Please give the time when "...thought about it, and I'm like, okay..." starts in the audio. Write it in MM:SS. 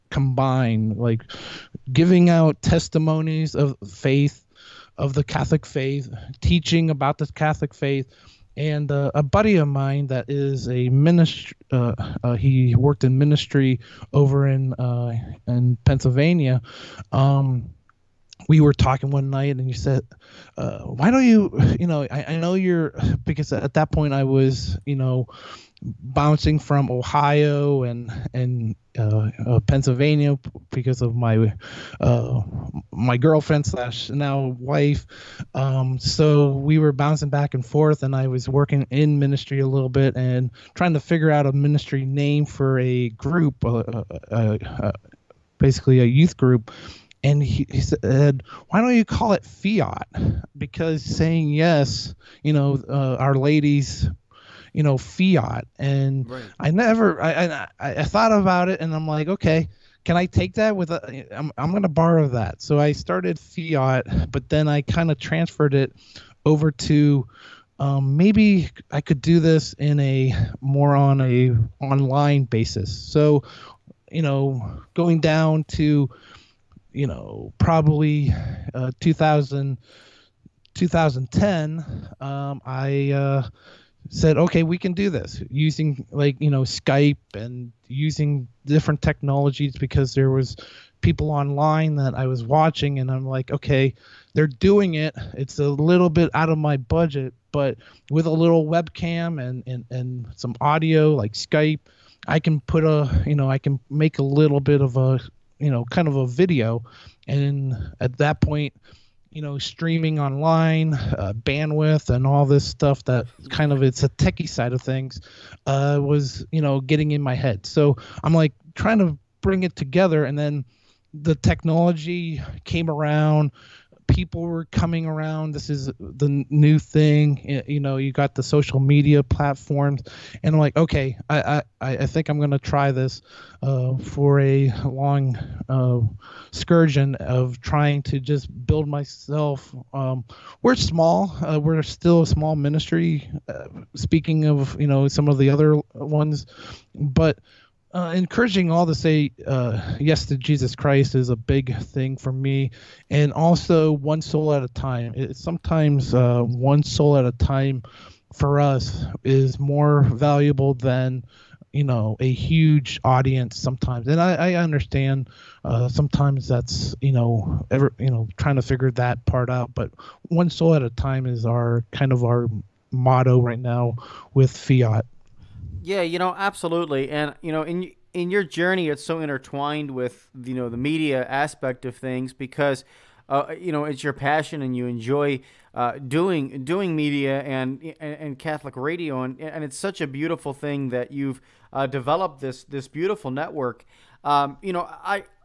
00:58.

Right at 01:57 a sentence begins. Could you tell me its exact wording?
So I'm like trying to bring it together.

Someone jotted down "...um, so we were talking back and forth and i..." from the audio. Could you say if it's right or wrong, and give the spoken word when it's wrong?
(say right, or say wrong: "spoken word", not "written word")
wrong: "bouncing", not "talking".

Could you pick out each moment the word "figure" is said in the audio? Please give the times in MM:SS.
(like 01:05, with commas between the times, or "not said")
00:41, 02:48.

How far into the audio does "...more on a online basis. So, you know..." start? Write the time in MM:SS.
01:10.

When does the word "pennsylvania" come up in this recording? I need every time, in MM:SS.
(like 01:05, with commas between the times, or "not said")
00:15, 00:29.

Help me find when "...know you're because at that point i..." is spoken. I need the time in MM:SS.
00:22.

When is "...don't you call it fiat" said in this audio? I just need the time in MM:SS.
00:48.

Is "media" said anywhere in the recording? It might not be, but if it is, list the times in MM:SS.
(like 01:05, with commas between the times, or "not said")
02:08, 03:00, 03:06.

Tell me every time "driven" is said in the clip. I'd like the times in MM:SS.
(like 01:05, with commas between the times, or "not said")
not said.